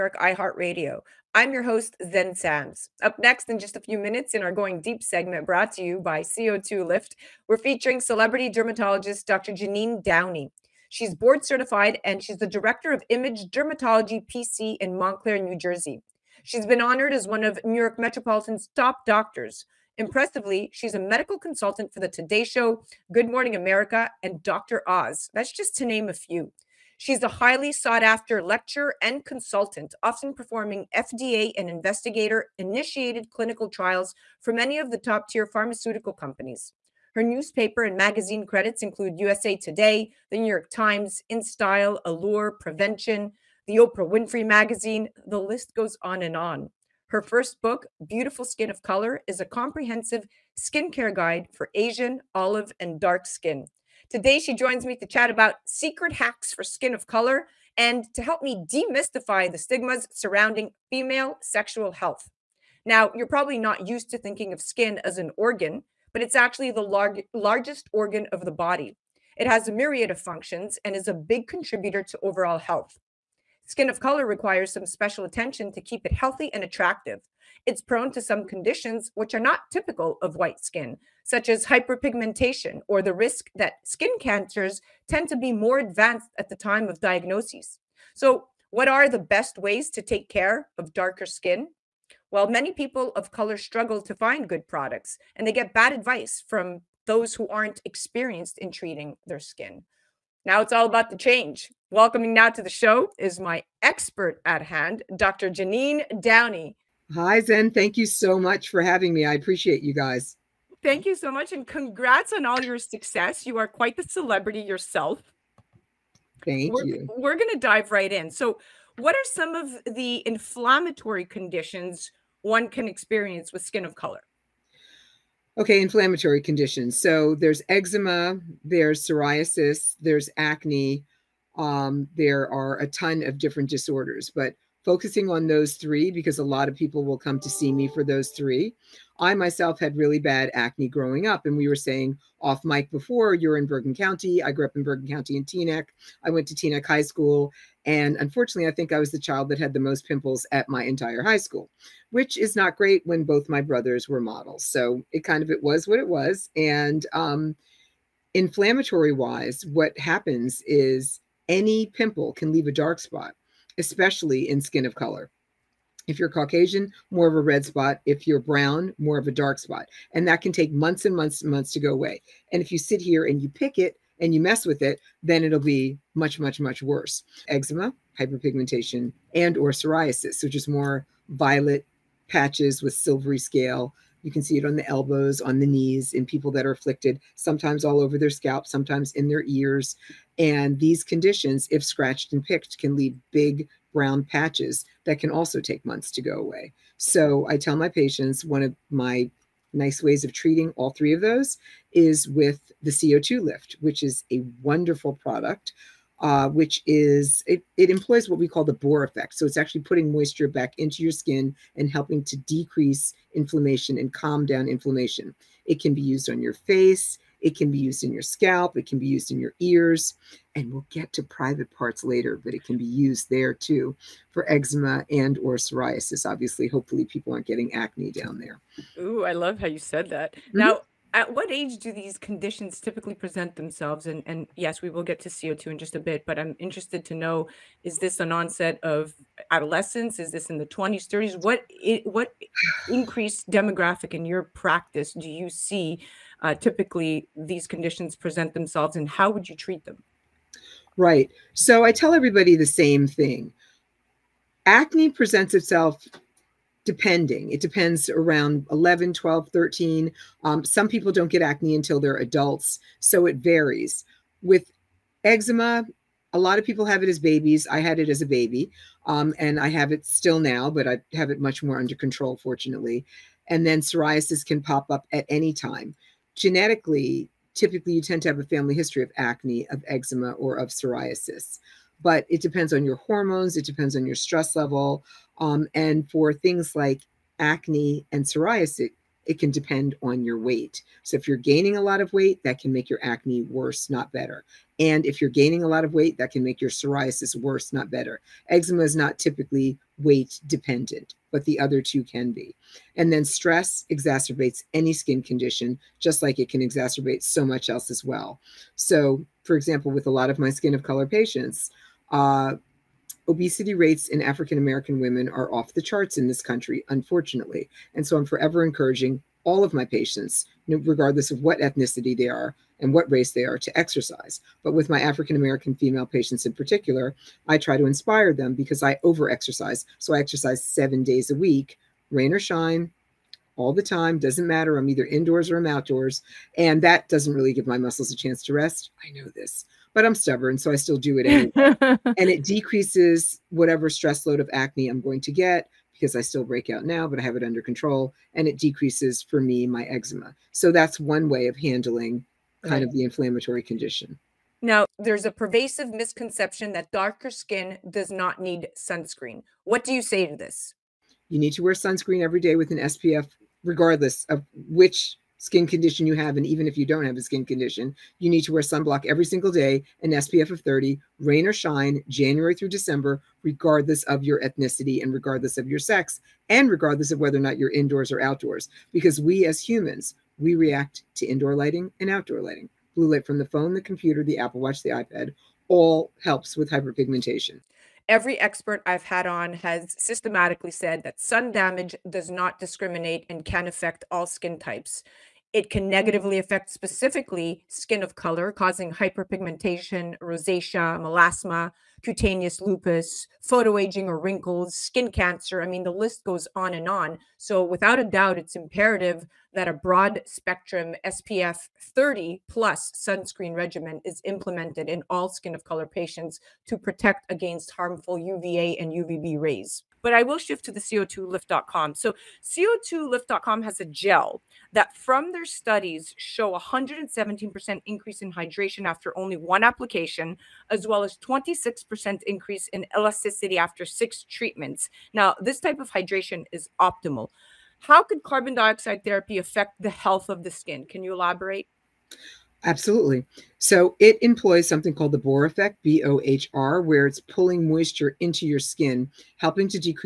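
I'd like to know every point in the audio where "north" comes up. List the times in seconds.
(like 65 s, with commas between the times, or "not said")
not said.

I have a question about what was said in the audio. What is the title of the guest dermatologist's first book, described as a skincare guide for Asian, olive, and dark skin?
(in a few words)
Beautiful Skin of Color.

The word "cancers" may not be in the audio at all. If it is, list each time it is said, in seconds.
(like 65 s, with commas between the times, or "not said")
84 s, 405 s.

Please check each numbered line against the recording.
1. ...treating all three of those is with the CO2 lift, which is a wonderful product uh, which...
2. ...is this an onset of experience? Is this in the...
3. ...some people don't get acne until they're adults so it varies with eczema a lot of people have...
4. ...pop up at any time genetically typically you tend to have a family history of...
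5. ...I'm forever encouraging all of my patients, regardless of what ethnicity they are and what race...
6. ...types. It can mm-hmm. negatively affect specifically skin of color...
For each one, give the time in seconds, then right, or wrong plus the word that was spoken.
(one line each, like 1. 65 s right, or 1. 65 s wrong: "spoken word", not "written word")
1. 200 s right
2. 237 s wrong: "adolescence", not "experience"
3. 260 s right
4. 274 s right
5. 318 s right
6. 394 s right.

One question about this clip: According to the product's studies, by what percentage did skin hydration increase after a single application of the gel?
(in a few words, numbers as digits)
117%.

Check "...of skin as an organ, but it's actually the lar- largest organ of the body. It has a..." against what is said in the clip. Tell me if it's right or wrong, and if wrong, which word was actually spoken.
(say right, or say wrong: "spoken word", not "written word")
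right.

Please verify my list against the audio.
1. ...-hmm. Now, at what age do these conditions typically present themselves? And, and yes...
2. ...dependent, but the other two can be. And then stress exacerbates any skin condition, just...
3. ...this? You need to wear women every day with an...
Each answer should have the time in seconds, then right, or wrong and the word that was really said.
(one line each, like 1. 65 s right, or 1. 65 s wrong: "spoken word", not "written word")
1. 230 s right
2. 300 s right
3. 360 s wrong: "sunscreen", not "women".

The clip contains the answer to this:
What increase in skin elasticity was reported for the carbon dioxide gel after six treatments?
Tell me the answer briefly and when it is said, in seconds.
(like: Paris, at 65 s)
26%, at 431 s.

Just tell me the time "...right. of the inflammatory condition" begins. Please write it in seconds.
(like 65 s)
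352 s.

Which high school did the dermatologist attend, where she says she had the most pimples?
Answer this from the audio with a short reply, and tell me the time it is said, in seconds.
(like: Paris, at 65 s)
Teaneck High School, at 146 s.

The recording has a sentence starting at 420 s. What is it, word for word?
But I will shift to the CO2lift.com.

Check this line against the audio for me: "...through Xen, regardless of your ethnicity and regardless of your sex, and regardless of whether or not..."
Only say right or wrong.
wrong.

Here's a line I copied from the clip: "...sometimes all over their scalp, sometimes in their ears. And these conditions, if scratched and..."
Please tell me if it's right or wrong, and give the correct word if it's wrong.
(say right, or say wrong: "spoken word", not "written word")
right.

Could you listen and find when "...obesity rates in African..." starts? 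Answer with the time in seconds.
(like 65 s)
313 s.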